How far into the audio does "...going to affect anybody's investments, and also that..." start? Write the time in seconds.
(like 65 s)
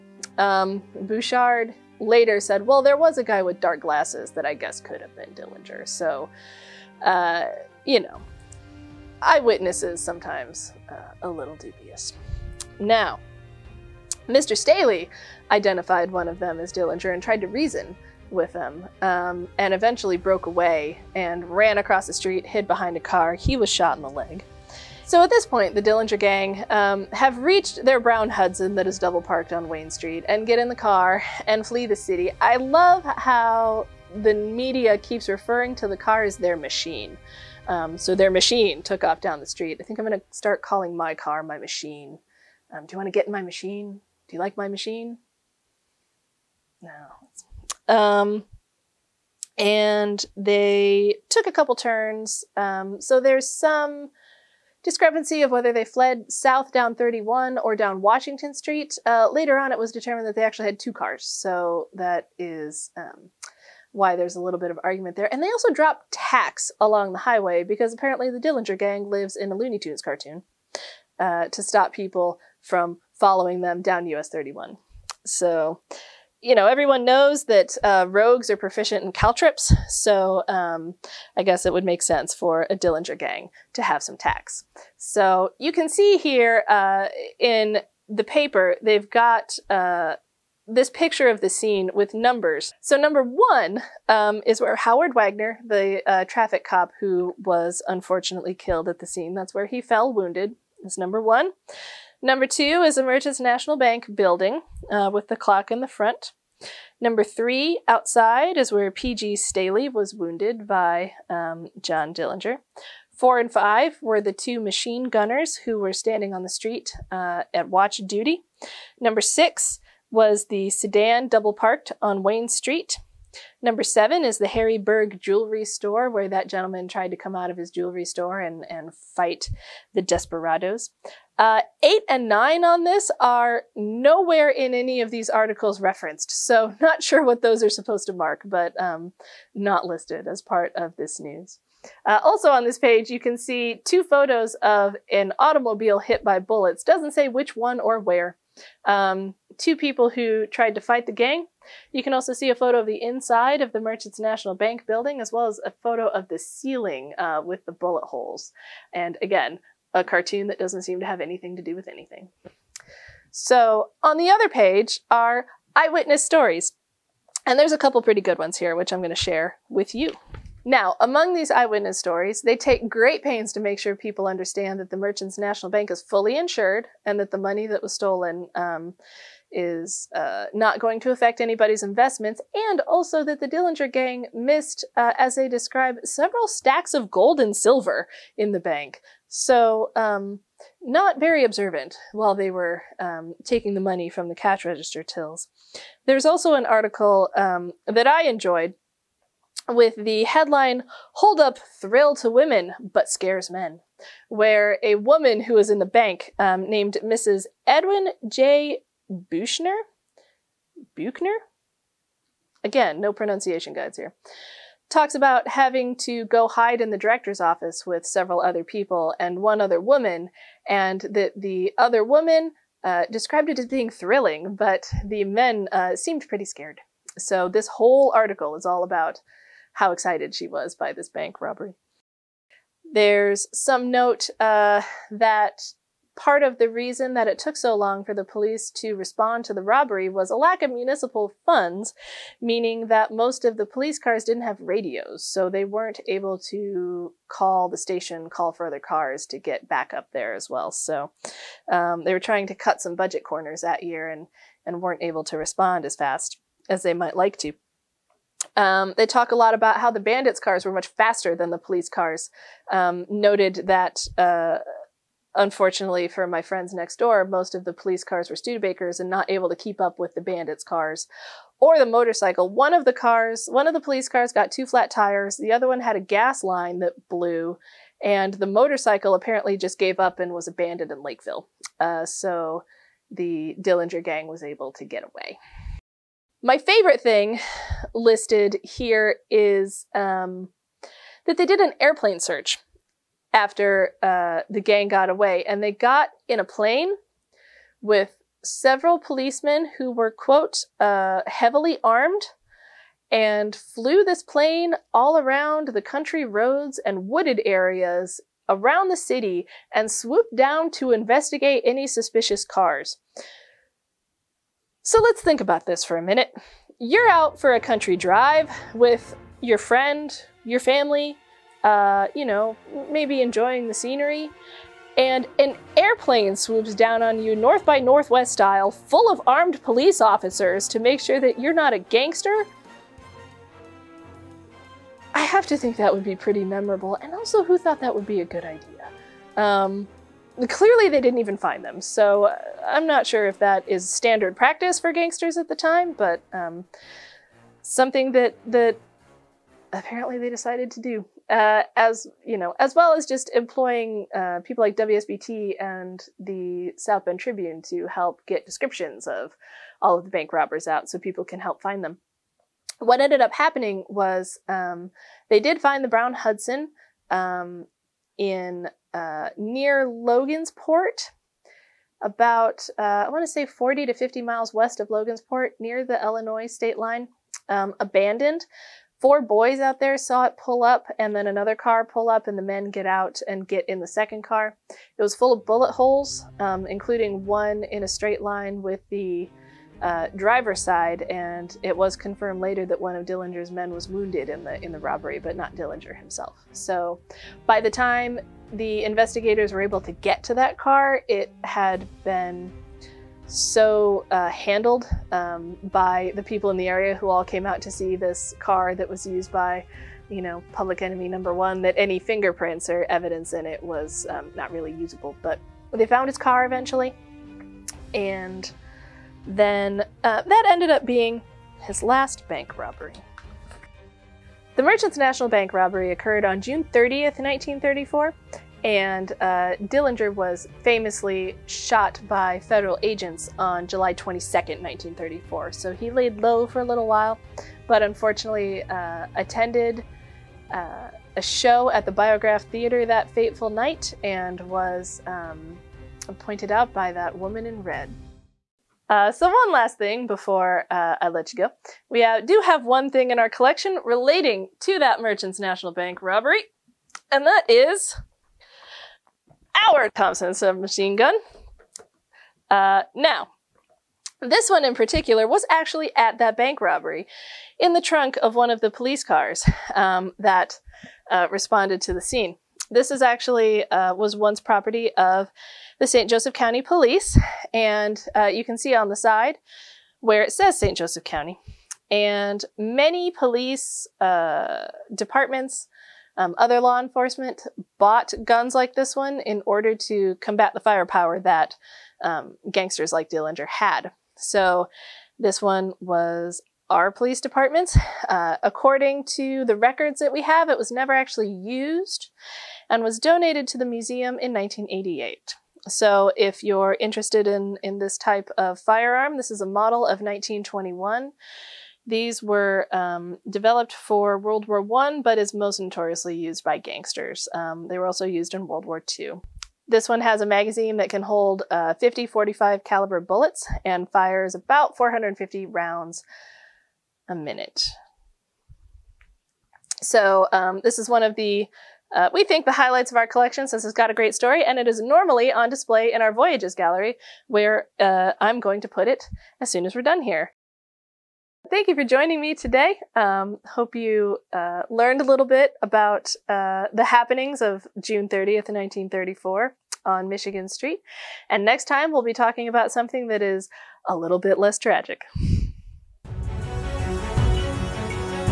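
180 s.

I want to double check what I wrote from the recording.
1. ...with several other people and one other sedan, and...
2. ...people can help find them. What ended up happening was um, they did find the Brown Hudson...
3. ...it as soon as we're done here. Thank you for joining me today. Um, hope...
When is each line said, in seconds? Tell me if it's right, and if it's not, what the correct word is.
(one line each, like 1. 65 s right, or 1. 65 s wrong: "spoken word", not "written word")
1. 217 s wrong: "woman", not "sedan"
2. 360 s right
3. 538 s right.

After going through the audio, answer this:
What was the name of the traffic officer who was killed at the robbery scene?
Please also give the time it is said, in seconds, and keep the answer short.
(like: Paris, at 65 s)
Howard Wagner, at 94 s.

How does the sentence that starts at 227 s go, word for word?
So this whole article is all about how excited she was by this bank robbery.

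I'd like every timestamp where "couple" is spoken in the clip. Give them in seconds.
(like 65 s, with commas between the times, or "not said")
51 s, 167 s.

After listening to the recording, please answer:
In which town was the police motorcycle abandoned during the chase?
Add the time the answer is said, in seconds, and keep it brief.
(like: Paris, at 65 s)
Lakeville, at 281 s.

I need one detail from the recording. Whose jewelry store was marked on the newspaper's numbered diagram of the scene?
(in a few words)
Harry Berg.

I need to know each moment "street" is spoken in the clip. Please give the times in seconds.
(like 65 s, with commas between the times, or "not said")
22 s, 29 s, 39 s, 58 s, 116 s, 122 s, 550 s.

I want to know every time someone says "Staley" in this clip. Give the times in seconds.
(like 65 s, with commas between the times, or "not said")
14 s, 109 s.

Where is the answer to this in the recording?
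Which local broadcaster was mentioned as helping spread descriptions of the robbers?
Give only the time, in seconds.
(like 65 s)
354 s.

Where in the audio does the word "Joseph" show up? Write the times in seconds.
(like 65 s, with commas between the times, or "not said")
476 s, 480 s.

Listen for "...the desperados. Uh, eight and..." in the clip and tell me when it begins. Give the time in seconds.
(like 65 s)
129 s.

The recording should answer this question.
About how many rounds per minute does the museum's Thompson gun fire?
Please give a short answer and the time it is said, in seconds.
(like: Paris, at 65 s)
450, at 524 s.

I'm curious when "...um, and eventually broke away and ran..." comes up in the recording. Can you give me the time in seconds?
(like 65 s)
19 s.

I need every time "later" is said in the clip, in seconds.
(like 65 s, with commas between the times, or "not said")
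2 s, 59 s, 392 s.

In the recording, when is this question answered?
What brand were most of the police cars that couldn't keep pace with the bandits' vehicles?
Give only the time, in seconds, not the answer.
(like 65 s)
268 s.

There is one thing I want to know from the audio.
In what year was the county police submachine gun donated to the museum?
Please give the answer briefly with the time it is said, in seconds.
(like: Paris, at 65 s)
1988, at 504 s.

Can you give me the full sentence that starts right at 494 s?
So this one was our police department.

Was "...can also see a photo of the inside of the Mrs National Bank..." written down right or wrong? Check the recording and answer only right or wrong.
wrong.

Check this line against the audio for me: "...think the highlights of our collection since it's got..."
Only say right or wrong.
right.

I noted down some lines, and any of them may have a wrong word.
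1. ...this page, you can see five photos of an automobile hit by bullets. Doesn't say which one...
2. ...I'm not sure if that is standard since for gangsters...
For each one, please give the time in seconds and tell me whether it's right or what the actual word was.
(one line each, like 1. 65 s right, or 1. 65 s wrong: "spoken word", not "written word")
1. 142 s wrong: "two", not "five"
2. 342 s wrong: "practice", not "since".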